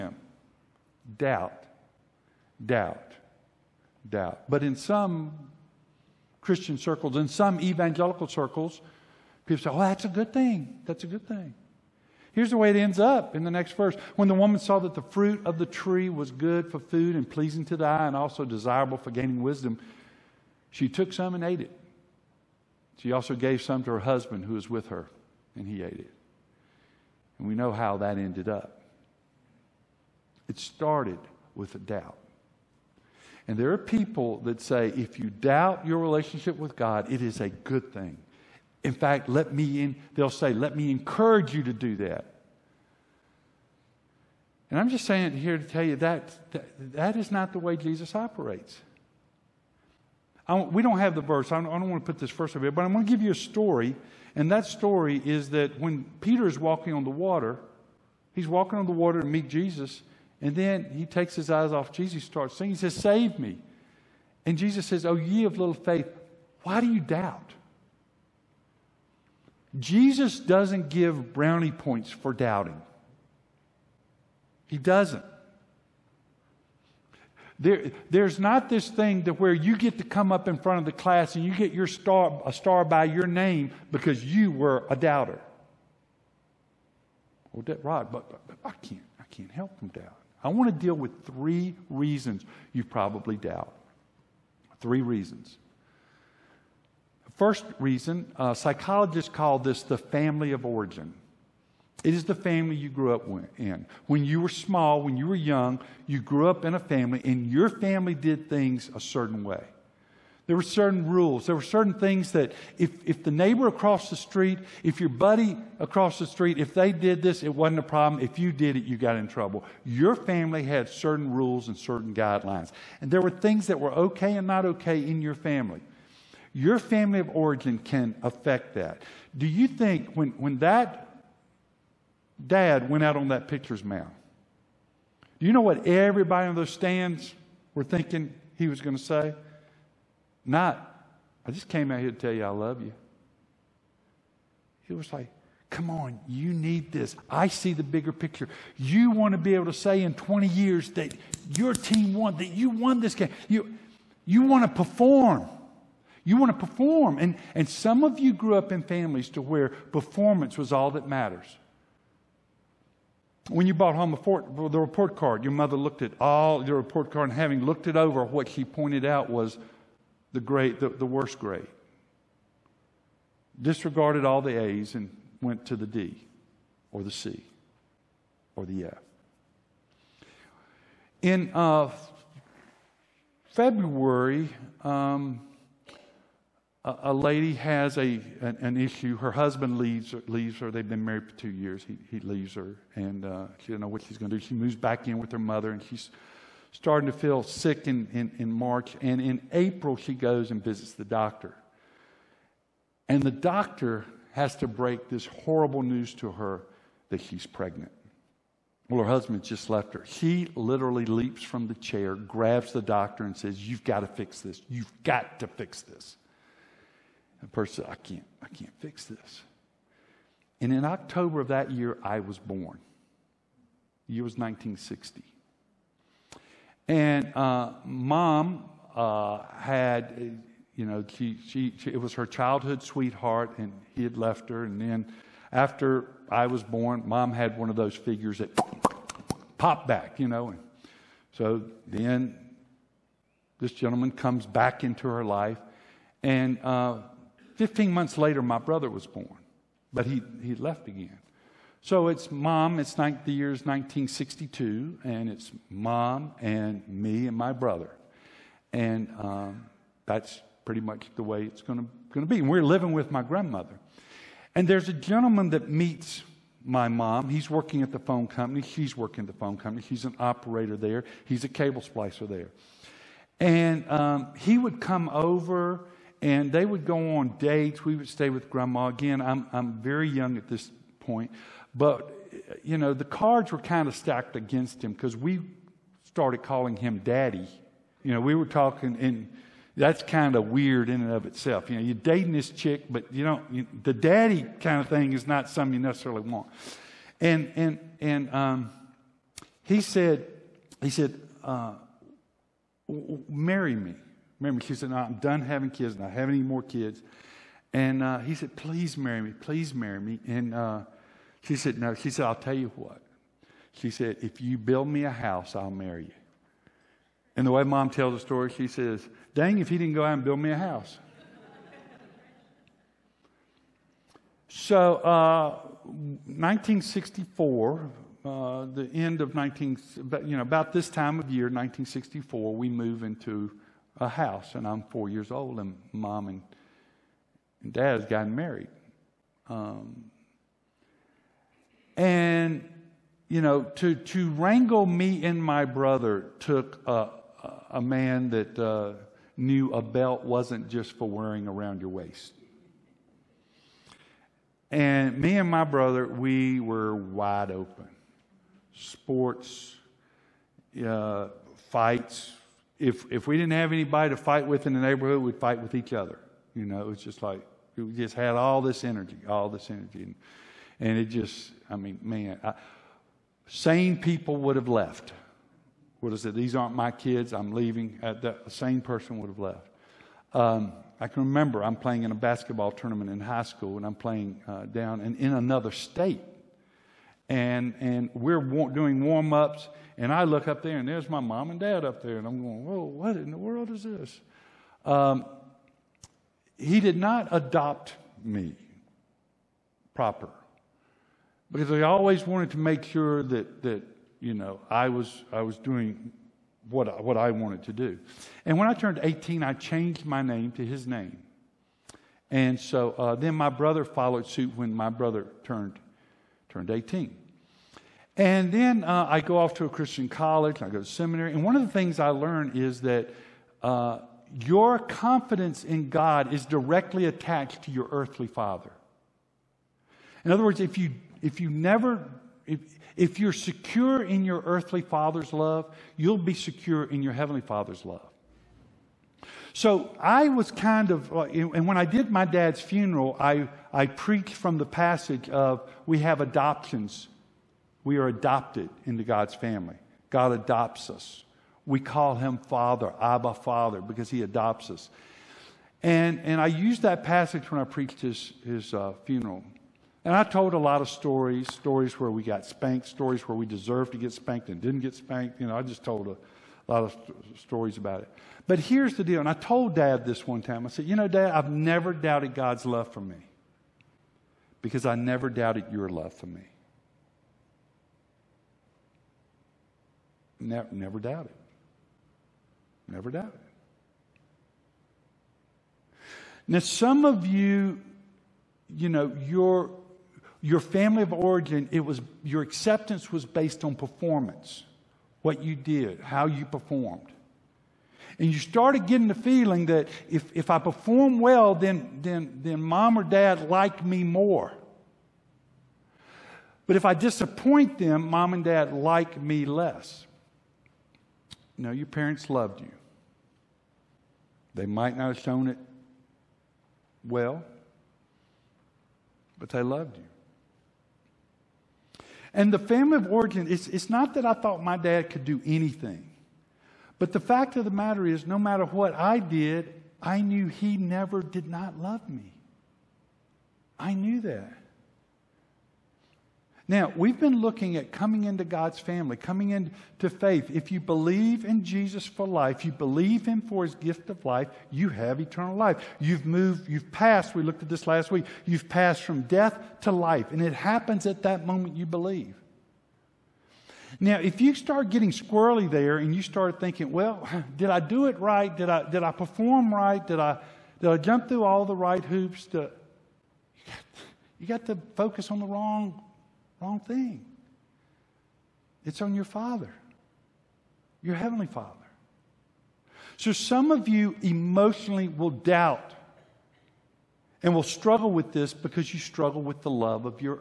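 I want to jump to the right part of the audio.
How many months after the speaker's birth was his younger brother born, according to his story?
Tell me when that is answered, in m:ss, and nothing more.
4:07.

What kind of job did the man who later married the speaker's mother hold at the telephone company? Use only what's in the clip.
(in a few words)
cable splicer.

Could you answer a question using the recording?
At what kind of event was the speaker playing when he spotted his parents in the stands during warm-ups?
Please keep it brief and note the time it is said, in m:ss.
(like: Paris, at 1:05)
basketball tournament, at 6:22.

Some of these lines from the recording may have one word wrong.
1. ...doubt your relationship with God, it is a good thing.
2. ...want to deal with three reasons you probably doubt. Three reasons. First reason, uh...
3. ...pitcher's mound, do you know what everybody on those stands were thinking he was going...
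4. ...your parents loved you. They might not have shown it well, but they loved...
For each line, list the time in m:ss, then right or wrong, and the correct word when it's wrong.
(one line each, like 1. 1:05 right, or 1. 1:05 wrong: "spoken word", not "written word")
1. 0:35 right
2. 1:30 right
3. 2:13 right
4. 8:31 right.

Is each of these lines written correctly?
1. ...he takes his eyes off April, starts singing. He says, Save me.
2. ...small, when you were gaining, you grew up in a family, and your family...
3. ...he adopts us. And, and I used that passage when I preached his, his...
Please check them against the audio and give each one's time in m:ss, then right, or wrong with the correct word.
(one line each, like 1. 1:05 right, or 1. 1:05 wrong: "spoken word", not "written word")
1. 1:00 wrong: "Jesus", not "April"
2. 1:44 wrong: "young", not "gaining"
3. 7:34 right.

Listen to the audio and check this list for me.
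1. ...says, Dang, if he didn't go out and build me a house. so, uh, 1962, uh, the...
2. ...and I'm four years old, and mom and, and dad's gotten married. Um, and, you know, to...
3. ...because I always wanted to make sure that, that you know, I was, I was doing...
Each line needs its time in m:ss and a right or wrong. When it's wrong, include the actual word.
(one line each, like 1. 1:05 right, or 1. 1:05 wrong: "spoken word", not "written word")
1. 5:18 wrong: "1964", not "1962"
2. 5:34 right
3. 6:41 right.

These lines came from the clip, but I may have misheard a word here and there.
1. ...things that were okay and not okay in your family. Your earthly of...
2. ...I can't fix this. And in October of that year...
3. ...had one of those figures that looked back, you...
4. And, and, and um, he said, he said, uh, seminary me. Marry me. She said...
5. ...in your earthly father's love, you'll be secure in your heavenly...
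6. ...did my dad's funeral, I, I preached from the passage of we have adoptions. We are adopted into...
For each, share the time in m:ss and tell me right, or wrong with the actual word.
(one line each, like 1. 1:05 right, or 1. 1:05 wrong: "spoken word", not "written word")
1. 2:03 wrong: "family", not "earthly"
2. 3:38 right
3. 3:57 wrong: "popped", not "looked"
4. 4:57 wrong: "marry", not "seminary"
5. 7:14 right
6. 7:21 right.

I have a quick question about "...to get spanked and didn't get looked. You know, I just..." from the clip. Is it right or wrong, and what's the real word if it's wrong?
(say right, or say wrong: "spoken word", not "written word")
wrong: "spanked", not "looked".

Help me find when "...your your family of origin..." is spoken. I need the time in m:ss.
8:09.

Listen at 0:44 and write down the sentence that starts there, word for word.
And I'm just saying it here to tell you that, that, that is not the way Jesus operates.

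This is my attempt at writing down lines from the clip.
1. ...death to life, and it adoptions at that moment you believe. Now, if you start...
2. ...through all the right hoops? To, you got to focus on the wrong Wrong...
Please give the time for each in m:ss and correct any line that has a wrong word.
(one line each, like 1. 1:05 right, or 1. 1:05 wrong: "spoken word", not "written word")
1. 9:09 wrong: "happens", not "adoptions"
2. 9:21 right.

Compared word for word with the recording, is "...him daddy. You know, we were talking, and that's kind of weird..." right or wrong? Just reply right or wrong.
right.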